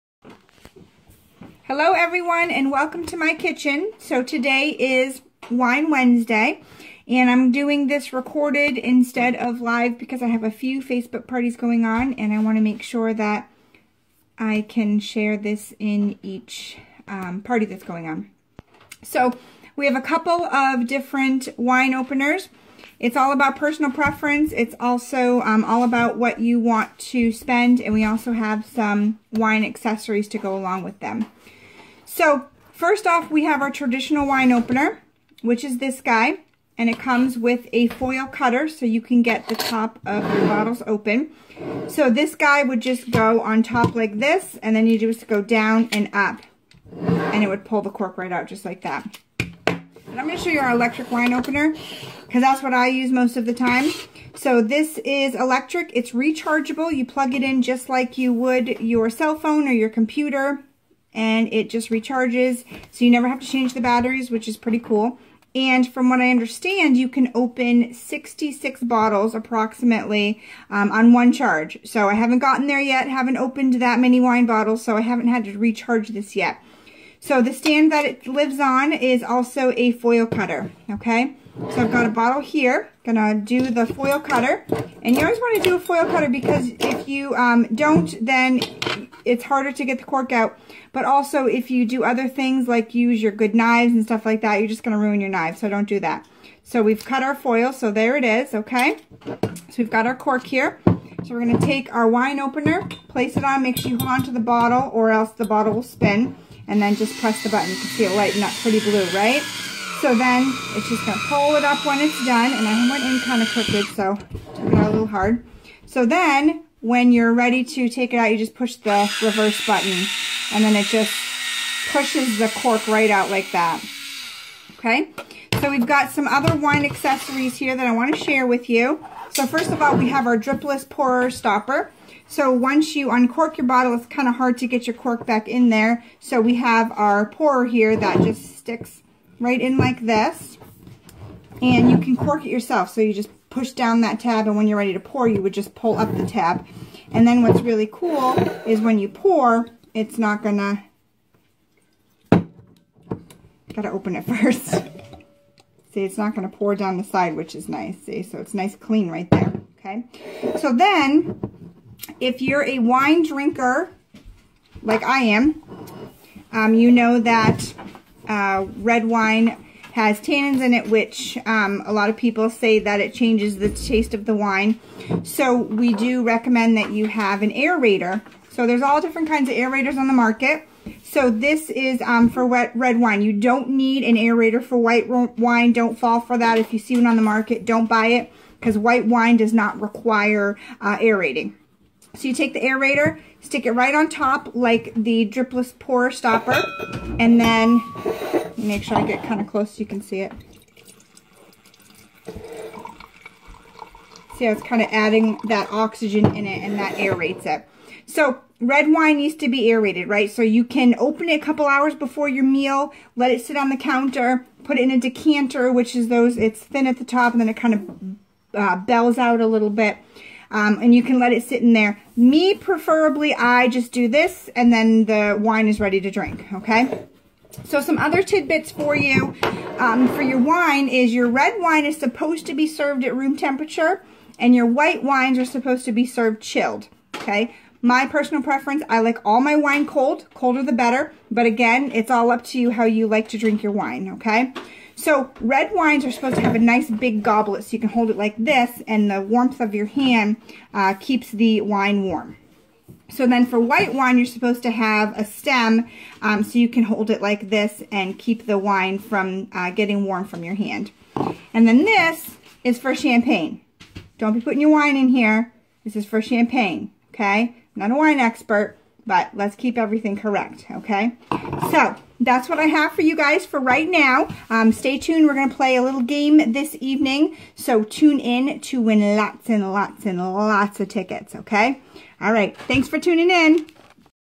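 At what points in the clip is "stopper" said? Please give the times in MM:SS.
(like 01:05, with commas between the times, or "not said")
02:11, 03:16.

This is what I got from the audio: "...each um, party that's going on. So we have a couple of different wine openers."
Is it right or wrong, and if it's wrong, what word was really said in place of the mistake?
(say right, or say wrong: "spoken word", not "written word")
right.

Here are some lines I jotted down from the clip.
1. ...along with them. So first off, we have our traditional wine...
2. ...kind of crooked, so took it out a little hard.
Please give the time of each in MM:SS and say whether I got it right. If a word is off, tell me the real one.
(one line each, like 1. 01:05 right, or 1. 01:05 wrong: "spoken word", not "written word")
1. 00:30 right
2. 01:53 right.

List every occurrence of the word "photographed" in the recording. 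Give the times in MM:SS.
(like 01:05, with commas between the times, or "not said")
not said.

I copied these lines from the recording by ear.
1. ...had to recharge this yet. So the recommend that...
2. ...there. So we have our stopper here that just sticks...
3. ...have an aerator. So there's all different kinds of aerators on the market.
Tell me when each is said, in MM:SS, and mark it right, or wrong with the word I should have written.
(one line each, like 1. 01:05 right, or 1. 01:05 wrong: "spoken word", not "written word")
1. 01:15 wrong: "stand", not "recommend"
2. 02:15 wrong: "pourer", not "stopper"
3. 02:57 right.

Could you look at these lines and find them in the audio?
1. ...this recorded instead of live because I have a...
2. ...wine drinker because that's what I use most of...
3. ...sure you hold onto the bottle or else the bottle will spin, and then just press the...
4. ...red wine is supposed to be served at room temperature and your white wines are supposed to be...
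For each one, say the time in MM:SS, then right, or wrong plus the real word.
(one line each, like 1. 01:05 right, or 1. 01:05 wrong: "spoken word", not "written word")
1. 00:07 right
2. 00:51 wrong: "opener", not "drinker"
3. 01:43 right
4. 03:51 right.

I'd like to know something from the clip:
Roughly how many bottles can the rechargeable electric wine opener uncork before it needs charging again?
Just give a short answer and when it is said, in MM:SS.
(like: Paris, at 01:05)
66, at 01:07.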